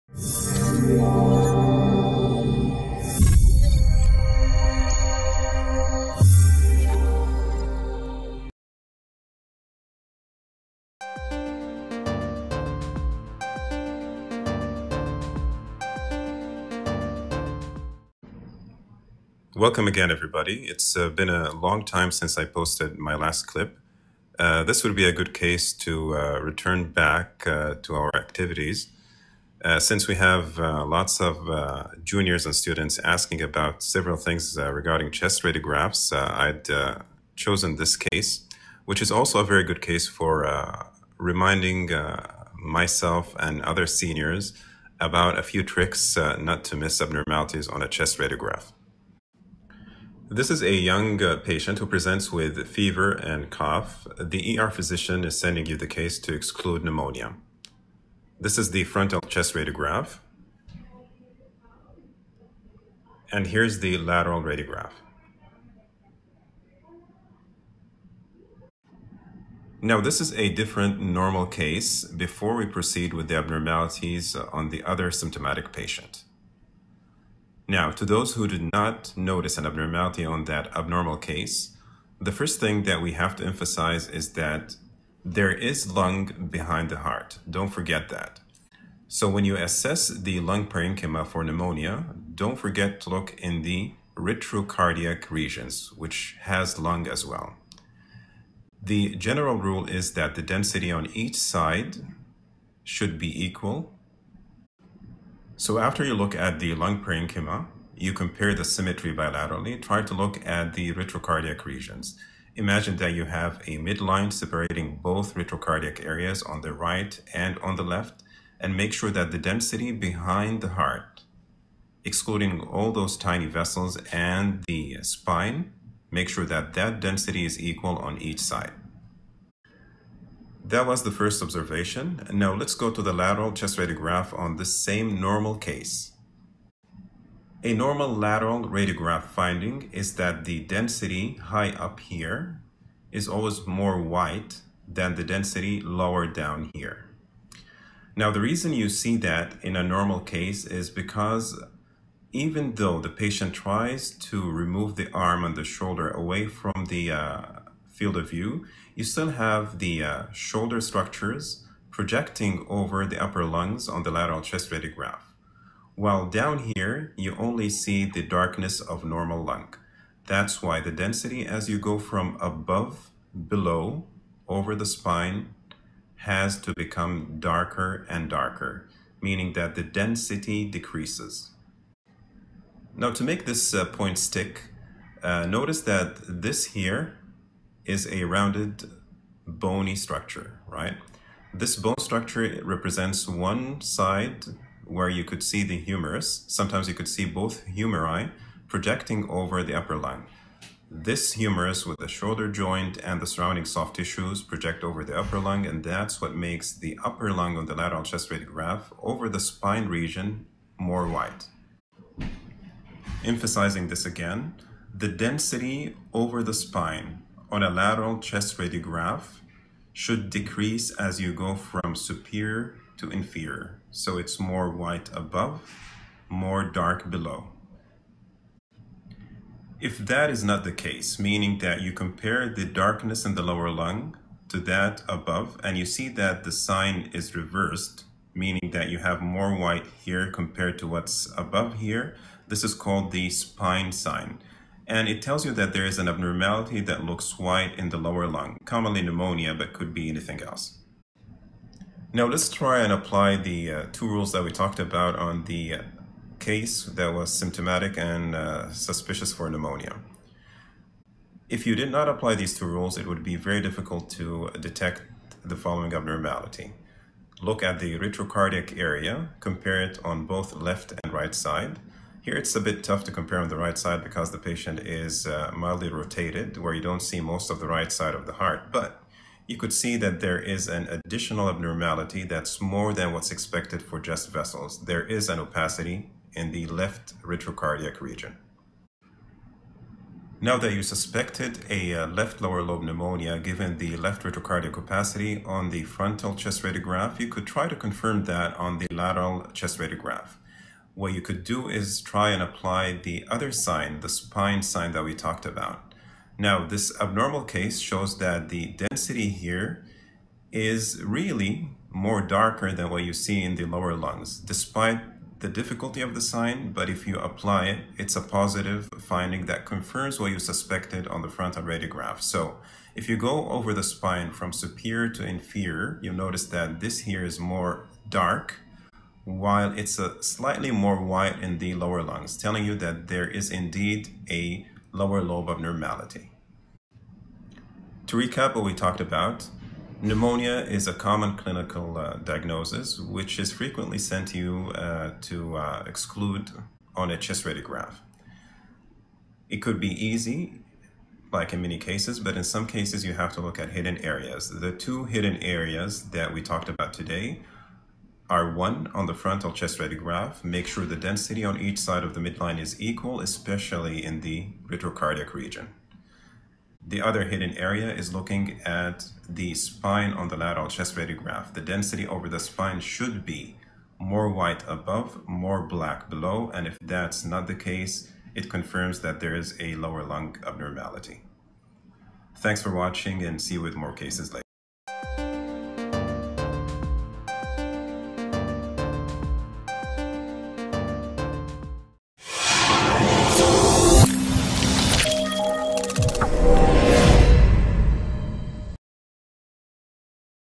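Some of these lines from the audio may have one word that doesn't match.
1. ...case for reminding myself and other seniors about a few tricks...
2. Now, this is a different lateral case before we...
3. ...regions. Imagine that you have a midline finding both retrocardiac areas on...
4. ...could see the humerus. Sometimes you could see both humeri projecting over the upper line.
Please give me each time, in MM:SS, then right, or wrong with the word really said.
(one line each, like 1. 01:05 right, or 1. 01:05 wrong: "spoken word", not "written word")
1. 00:39 right
2. 01:09 wrong: "normal", not "lateral"
3. 01:51 wrong: "separating", not "finding"
4. 03:15 right.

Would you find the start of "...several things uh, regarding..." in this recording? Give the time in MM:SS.
00:33.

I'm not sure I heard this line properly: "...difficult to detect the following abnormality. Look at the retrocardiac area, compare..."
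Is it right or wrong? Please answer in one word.
right.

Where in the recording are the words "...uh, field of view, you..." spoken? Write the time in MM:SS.
02:37.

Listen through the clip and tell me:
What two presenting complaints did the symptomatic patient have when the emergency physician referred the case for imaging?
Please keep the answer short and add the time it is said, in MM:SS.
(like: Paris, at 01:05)
fever and cough, at 00:52.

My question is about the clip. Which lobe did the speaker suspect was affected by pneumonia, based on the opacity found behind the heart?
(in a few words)
left lower lobe.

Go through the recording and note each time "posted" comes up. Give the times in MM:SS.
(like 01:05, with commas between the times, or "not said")
00:22.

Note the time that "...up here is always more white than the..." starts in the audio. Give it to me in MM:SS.
02:21.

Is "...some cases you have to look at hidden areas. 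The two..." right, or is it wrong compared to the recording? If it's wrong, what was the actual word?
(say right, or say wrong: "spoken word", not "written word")
right.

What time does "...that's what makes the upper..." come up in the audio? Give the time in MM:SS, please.
03:25.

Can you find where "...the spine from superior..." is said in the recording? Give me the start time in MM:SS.
05:23.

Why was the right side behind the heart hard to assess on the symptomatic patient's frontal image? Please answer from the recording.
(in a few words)
mildly rotated.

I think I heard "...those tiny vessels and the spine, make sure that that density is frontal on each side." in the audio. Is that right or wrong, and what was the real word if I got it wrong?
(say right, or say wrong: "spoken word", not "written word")
wrong: "equal", not "frontal".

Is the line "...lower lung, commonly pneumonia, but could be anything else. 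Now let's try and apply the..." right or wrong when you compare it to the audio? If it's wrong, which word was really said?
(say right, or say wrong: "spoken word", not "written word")
right.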